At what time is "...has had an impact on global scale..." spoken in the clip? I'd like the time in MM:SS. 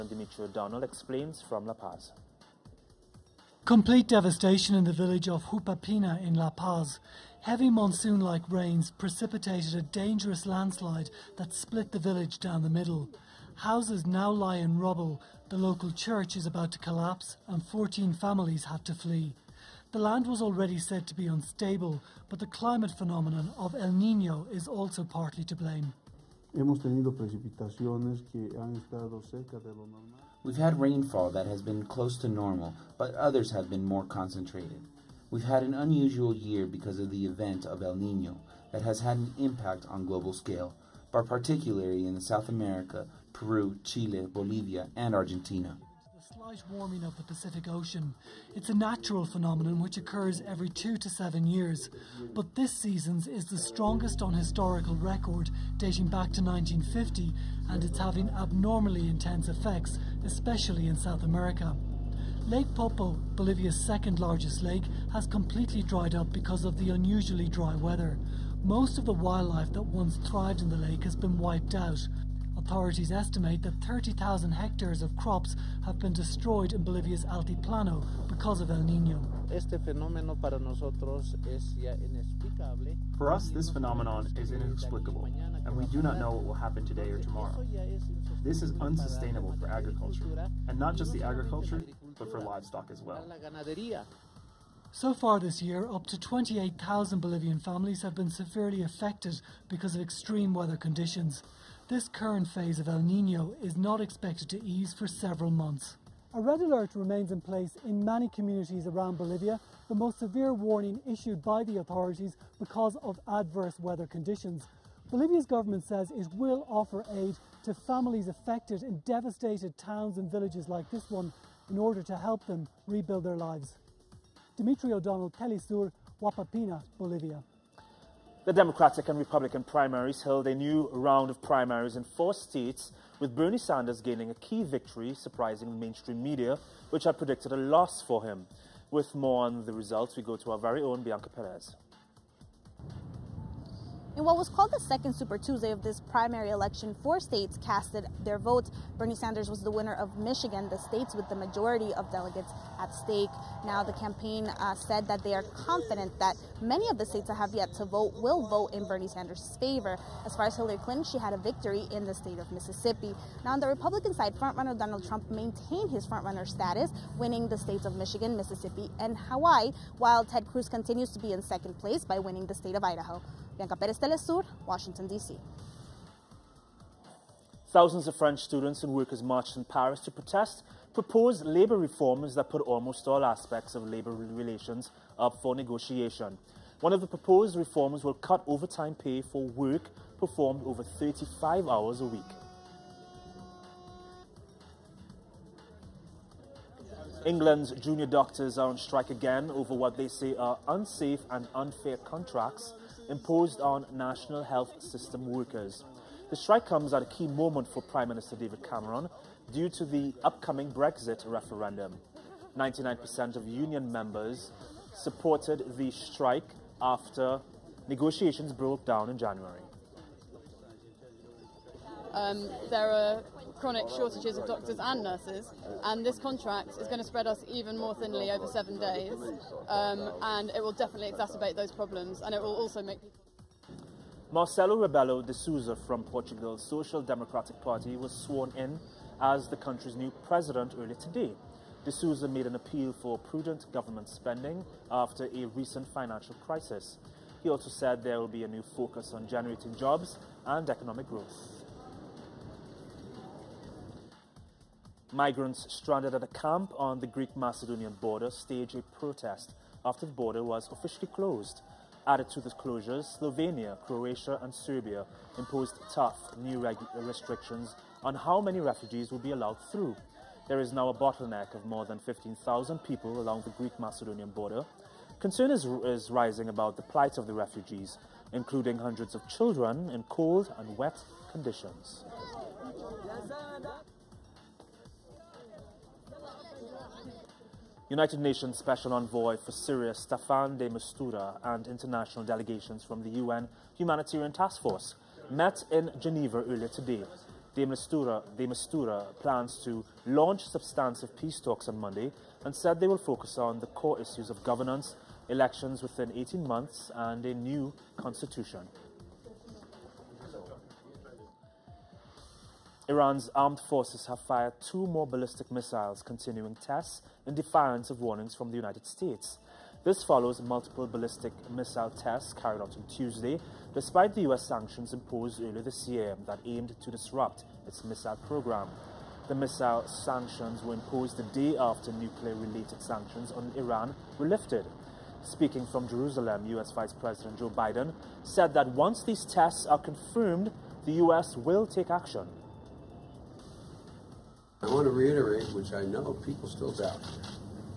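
00:38.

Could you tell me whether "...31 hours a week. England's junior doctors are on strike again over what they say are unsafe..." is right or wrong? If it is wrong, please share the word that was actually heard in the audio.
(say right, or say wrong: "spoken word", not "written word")
wrong: "35", not "31".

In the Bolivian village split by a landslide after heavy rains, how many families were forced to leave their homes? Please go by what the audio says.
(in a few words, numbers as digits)
14.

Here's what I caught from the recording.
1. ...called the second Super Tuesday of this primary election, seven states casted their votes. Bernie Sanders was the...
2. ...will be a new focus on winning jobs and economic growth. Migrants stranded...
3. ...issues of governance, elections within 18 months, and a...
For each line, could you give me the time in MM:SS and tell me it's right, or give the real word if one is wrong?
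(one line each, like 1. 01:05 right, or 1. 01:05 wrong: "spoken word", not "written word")
1. 02:24 wrong: "four", not "seven"
2. 04:08 wrong: "generating", not "winning"
3. 05:04 right.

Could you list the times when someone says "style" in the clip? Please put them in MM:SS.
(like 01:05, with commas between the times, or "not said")
not said.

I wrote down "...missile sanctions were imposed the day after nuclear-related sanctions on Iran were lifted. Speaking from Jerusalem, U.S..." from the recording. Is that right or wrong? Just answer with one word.
right.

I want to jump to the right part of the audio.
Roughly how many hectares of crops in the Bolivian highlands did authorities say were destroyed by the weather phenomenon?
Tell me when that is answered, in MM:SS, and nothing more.
01:13.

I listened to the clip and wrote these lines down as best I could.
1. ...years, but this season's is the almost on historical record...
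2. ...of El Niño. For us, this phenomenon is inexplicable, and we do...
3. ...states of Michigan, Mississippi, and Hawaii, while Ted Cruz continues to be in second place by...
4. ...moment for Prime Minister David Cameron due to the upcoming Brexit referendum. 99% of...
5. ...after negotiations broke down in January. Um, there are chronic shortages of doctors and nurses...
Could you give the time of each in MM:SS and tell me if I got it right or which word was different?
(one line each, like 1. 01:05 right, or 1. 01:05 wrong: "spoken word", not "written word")
1. 00:51 wrong: "strongest", not "almost"
2. 01:18 right
3. 02:47 right
4. 03:27 right
5. 03:36 right.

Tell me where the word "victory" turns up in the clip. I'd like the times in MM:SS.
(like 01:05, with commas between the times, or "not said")
02:14, 02:41.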